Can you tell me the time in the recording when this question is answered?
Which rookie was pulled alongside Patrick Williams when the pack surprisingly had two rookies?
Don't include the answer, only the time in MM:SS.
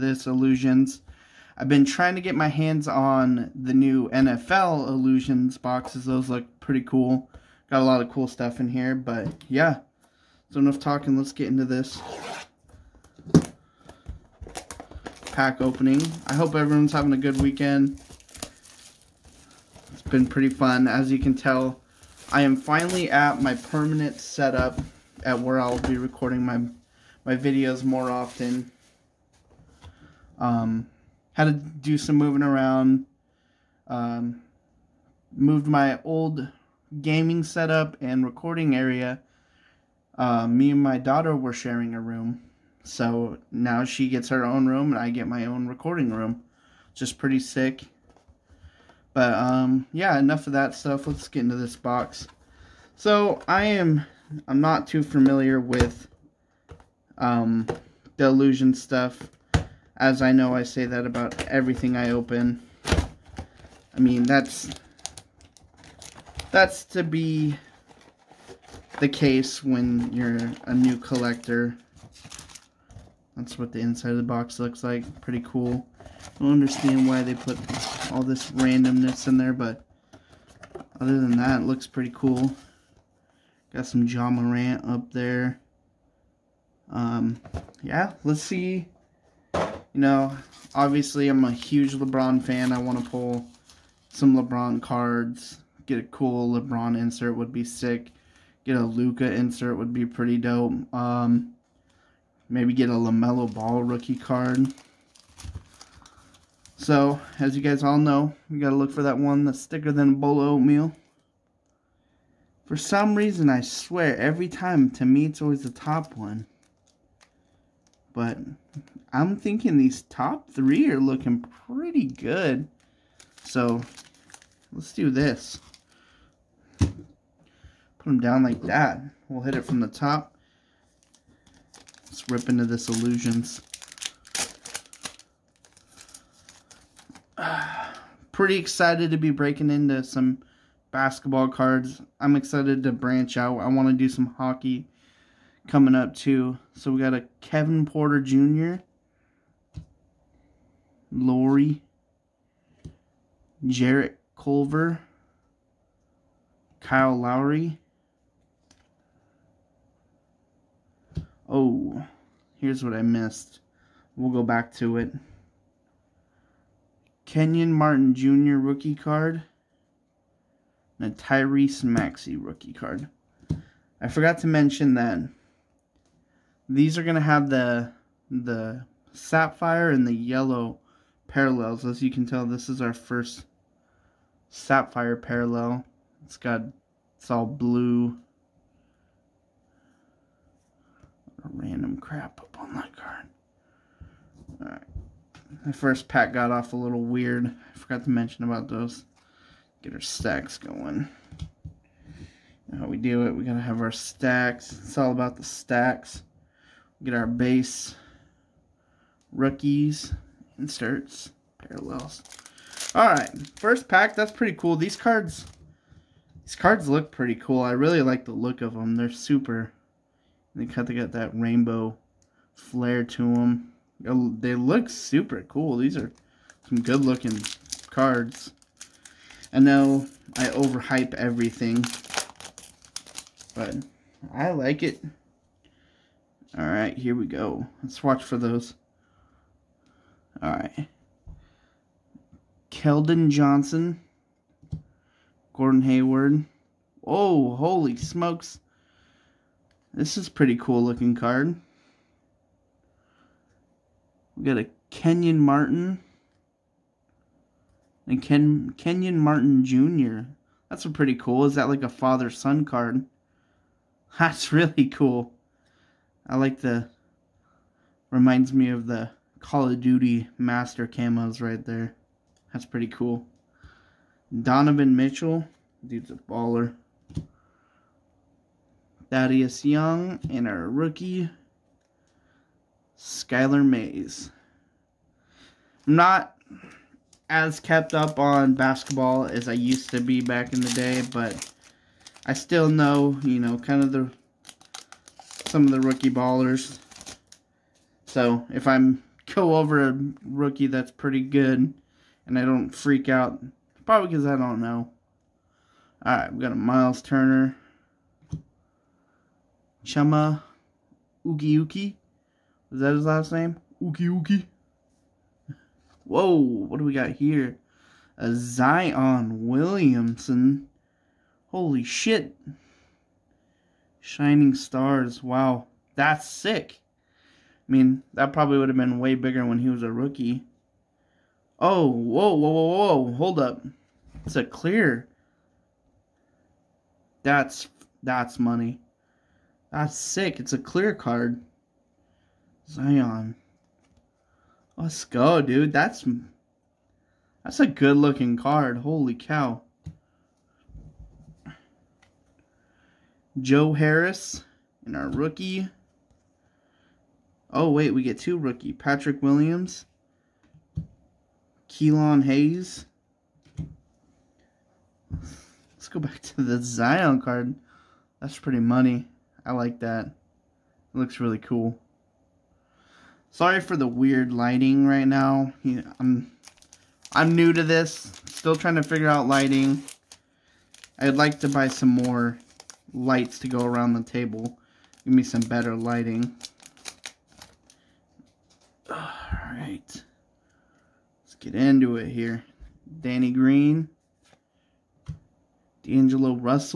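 06:01.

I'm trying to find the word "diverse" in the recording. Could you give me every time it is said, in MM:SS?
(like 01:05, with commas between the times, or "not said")
not said.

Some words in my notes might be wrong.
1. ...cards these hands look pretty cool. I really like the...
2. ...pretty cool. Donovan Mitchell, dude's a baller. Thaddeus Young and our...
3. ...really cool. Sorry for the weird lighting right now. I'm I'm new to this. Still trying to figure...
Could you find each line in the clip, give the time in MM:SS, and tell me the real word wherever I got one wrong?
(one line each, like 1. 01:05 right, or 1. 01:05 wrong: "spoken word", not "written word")
1. 03:34 wrong: "cards", not "hands"
2. 04:32 right
3. 06:11 right.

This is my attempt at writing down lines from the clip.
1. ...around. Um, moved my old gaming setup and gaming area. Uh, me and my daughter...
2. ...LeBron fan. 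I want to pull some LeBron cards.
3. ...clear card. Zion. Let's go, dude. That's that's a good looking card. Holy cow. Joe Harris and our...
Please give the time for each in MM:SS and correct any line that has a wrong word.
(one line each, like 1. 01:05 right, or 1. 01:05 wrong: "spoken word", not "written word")
1. 00:32 wrong: "recording", not "gaming"
2. 01:31 right
3. 05:40 right.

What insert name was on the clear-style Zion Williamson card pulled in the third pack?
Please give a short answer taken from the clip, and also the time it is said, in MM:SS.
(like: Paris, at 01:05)
Shining Stars, at 05:24.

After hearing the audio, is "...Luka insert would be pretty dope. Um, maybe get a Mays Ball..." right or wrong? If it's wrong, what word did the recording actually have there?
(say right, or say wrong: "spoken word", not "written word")
wrong: "LaMelo", not "Mays".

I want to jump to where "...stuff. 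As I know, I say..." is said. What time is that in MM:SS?
00:58.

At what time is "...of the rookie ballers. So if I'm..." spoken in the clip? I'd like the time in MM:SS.
04:55.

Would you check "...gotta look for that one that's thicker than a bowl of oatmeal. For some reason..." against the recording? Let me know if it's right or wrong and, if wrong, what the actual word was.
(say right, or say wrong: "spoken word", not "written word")
right.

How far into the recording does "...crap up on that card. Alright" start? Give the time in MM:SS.
03:11.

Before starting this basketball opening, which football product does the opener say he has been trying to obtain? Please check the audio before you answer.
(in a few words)
NFL Illusions boxes.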